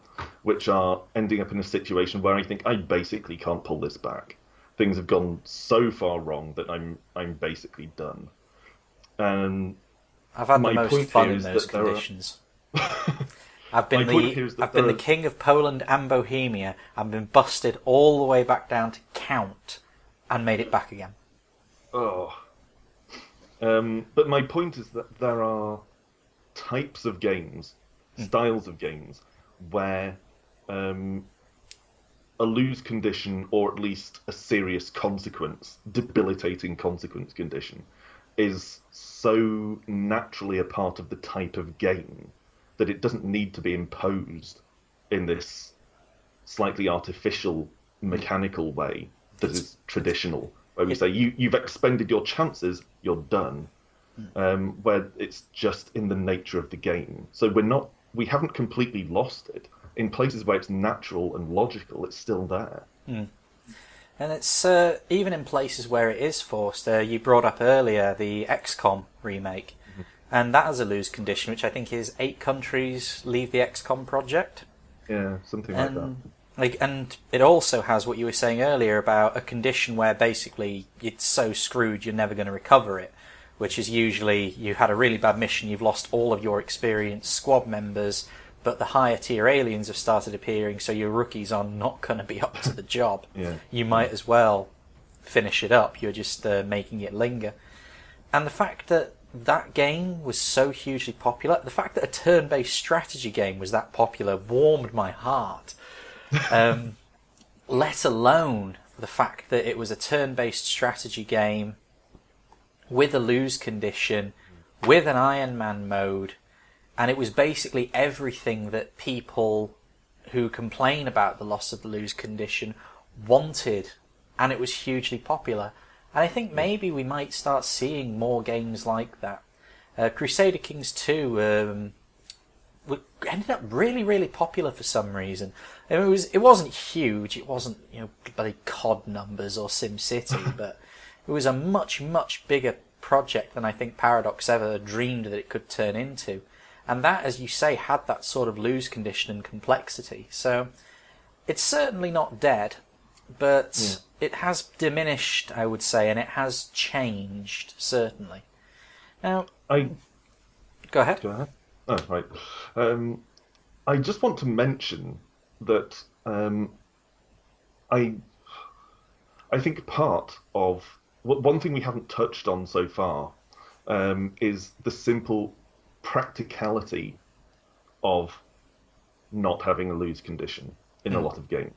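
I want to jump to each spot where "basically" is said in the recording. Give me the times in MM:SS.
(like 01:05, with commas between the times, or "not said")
00:02, 00:07, 01:20, 01:57.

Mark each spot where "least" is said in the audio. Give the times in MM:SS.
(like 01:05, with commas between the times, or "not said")
00:33.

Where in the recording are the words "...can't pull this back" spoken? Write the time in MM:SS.
00:03.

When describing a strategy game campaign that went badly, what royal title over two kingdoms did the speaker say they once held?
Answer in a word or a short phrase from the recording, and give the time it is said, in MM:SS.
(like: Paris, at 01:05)
King of Poland and Bohemia, at 00:14.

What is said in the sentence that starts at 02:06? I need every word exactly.
And I think maybe we might start seeing more games like that.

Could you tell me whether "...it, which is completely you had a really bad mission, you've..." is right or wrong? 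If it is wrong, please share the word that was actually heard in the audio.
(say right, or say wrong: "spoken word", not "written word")
wrong: "usually", not "completely".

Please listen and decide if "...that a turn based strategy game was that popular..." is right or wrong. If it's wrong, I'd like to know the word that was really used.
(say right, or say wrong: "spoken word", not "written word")
right.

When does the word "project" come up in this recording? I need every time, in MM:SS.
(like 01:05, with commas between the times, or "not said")
01:14, 02:23.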